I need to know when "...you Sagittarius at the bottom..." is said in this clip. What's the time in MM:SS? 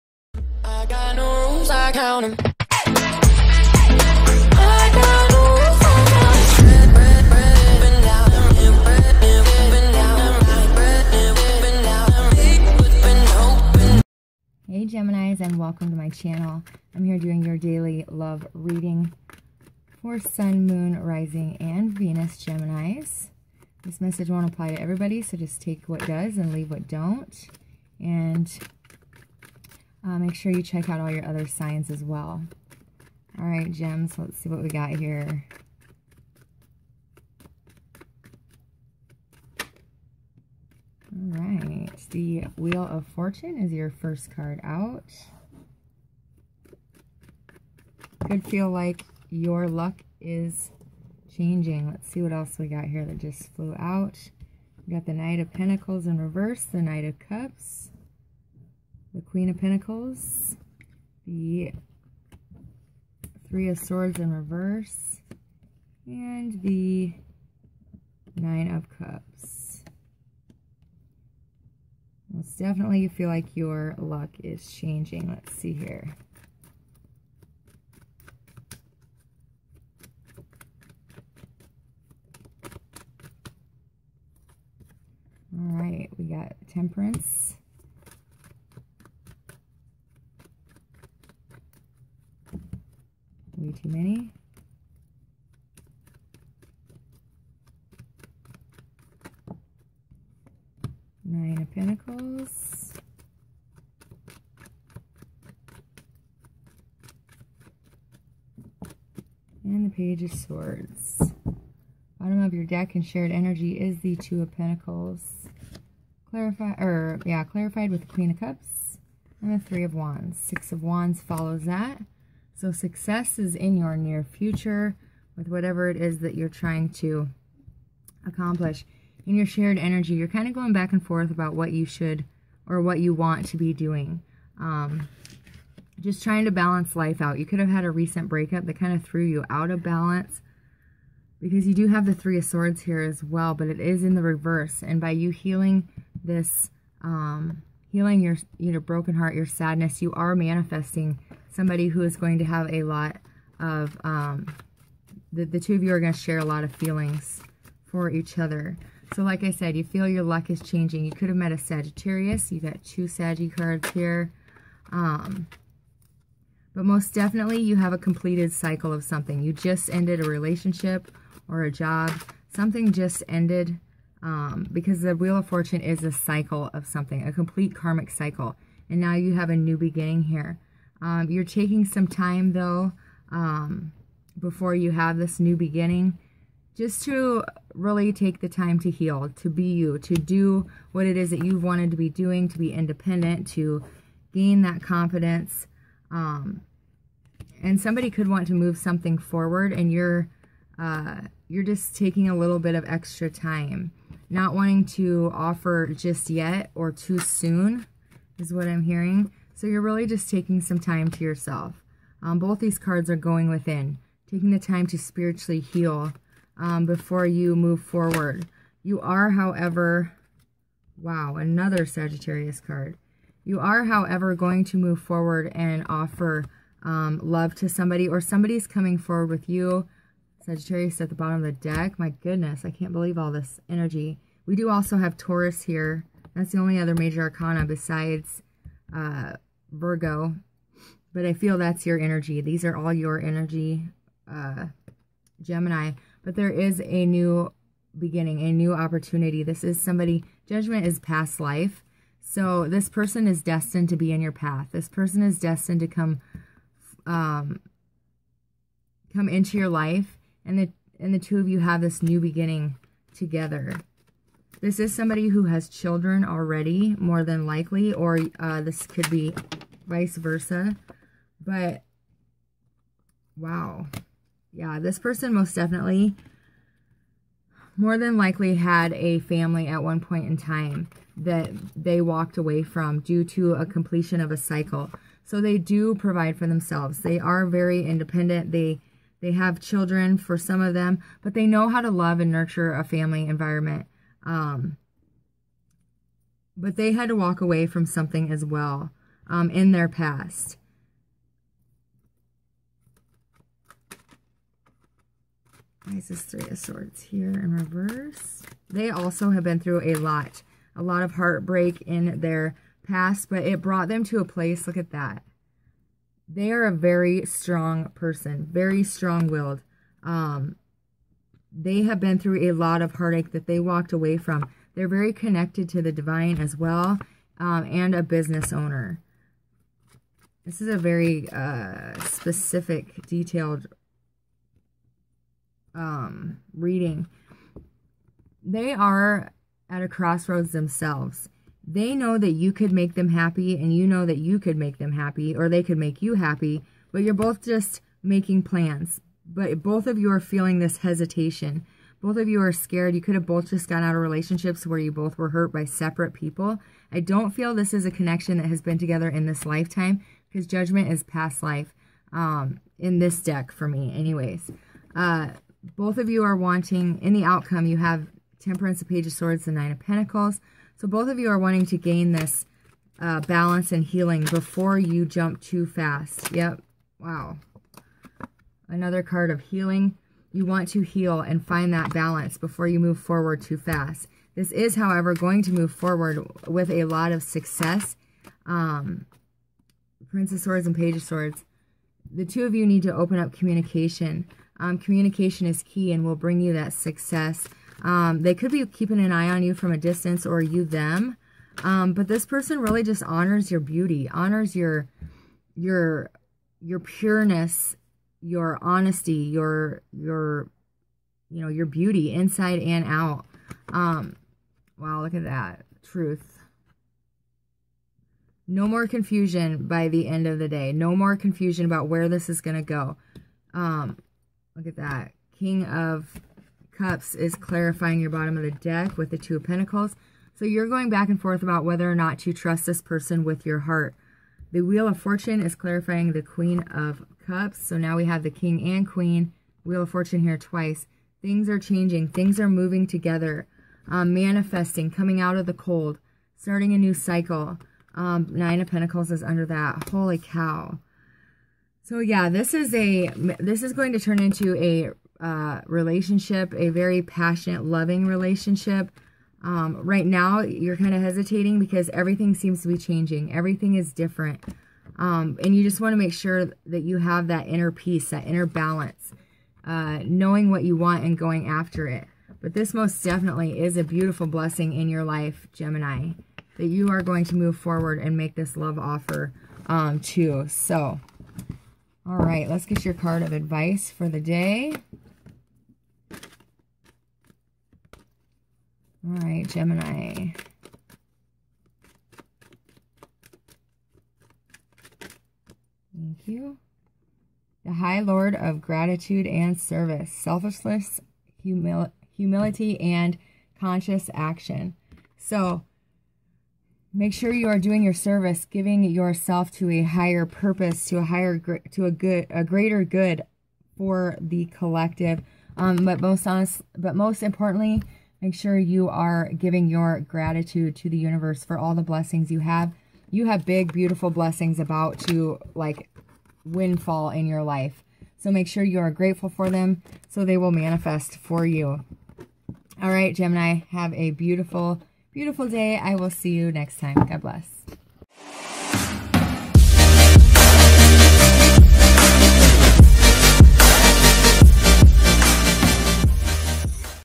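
03:49.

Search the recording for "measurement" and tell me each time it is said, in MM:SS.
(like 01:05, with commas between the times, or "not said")
not said.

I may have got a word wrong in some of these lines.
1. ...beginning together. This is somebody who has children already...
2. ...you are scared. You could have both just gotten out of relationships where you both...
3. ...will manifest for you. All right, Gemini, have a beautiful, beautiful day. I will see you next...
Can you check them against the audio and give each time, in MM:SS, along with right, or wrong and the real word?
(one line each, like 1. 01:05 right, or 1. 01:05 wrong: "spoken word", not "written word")
1. 04:22 right
2. 05:52 right
3. 08:50 right.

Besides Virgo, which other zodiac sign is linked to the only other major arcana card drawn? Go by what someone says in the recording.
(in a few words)
Taurus.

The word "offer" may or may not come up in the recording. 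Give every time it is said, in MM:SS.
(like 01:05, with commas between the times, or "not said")
03:25, 03:45, 07:58.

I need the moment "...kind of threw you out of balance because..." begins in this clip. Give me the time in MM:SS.
02:18.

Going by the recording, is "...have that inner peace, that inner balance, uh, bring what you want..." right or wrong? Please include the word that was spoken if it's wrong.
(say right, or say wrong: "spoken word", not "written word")
wrong: "knowing", not "bring".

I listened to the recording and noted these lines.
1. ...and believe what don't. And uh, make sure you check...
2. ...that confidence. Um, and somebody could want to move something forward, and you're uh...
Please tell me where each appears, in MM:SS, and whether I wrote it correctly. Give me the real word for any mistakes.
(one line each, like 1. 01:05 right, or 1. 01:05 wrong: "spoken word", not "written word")
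1. 00:26 wrong: "leave", not "believe"
2. 03:14 right.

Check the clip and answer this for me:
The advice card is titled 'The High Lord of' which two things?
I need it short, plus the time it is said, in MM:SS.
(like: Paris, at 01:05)
Gratitude and Service, at 08:17.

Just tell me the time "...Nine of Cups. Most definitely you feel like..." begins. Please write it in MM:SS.
01:08.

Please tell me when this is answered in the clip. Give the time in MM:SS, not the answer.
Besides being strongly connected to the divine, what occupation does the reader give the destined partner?
05:27.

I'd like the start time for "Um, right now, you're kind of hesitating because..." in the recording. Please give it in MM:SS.
07:39.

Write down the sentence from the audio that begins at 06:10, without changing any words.
So both of you are wanting to gain this uh, balance and healing before you jump too fast.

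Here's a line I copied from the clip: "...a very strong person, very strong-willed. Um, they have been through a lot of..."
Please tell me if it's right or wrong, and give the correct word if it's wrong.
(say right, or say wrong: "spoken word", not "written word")
right.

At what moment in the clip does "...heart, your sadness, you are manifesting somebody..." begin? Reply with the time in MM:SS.
02:29.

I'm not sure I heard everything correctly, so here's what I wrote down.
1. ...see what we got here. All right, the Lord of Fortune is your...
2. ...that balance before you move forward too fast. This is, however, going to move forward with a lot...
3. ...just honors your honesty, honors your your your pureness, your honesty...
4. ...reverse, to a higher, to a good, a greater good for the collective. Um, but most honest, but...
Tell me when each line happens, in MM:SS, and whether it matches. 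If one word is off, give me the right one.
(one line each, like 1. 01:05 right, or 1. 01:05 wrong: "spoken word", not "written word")
1. 00:34 wrong: "Wheel", not "Lord"
2. 06:21 right
3. 06:42 wrong: "beauty", not "honesty"
4. 08:30 wrong: "purpose", not "reverse".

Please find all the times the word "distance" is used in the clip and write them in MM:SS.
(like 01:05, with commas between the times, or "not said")
06:39.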